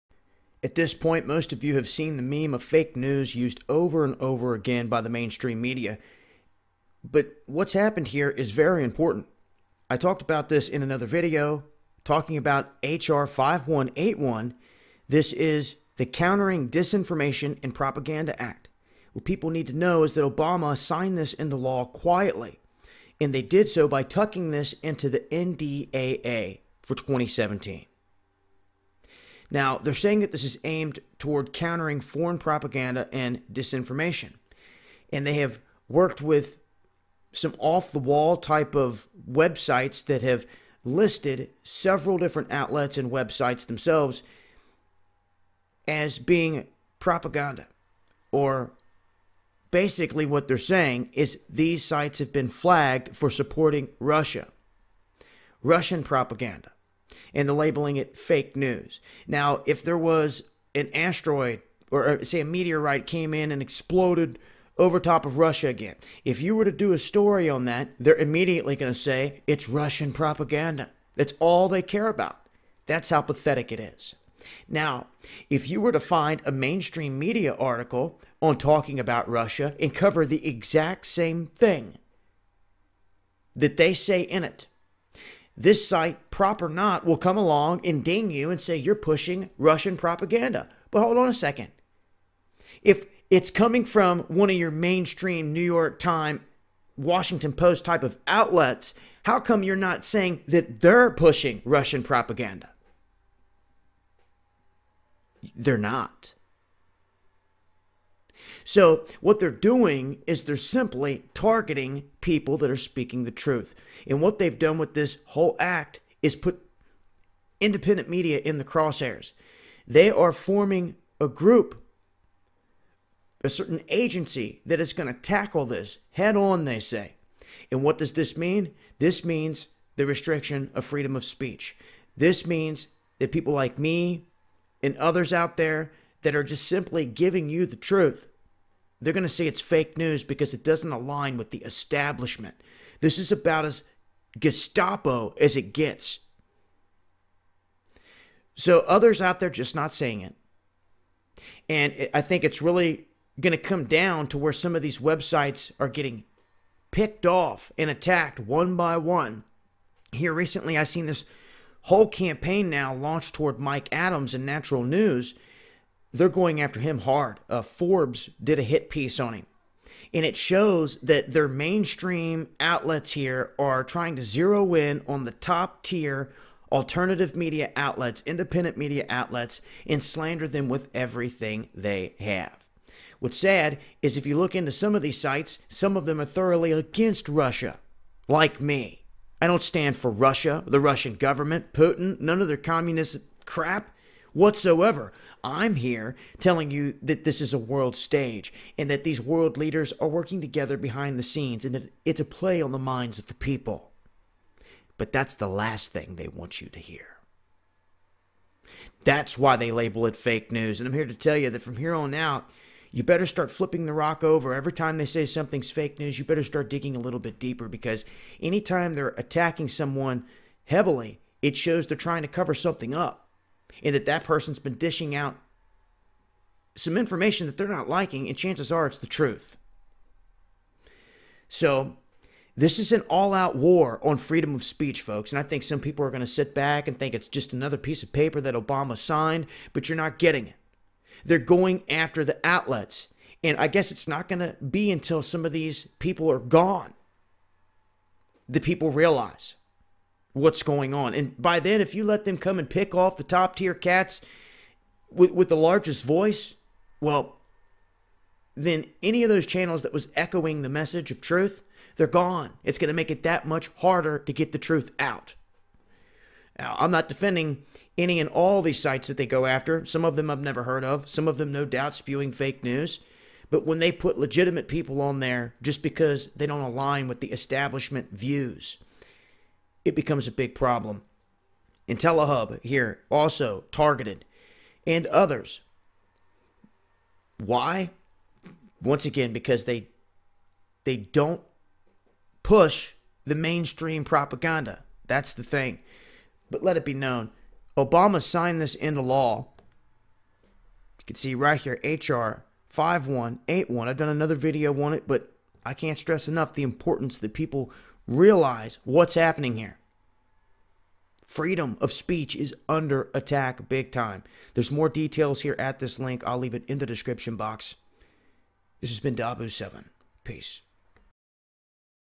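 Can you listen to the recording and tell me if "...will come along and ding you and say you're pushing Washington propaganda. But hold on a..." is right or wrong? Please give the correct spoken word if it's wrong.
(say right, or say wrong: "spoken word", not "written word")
wrong: "Russian", not "Washington".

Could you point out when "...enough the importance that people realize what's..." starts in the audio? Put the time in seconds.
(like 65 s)
306 s.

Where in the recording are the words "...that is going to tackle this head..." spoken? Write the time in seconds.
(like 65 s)
124 s.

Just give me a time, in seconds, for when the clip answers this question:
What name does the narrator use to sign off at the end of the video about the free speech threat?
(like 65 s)
319 s.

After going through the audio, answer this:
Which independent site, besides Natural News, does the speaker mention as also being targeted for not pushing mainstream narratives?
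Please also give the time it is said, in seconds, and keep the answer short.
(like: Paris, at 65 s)
IntelliHub, at 281 s.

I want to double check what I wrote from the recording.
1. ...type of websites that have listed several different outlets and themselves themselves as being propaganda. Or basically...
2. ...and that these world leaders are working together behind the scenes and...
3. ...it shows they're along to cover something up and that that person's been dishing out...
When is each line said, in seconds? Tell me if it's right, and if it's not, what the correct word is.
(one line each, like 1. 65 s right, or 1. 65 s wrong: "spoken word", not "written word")
1. 38 s wrong: "websites", not "themselves"
2. 198 s right
3. 221 s wrong: "trying", not "along".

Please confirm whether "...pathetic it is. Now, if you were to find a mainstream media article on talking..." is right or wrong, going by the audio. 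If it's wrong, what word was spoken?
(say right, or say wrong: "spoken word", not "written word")
right.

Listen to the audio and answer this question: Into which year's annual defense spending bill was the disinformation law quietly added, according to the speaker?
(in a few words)
NDAA for 2017.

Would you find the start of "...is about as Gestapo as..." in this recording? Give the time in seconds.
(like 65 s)
143 s.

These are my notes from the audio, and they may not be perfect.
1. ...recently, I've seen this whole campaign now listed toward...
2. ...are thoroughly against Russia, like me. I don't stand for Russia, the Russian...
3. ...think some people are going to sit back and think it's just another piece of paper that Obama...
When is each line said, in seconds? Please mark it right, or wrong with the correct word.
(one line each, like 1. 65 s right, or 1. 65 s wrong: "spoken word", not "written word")
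1. 160 s wrong: "launched", not "listed"
2. 186 s right
3. 235 s right.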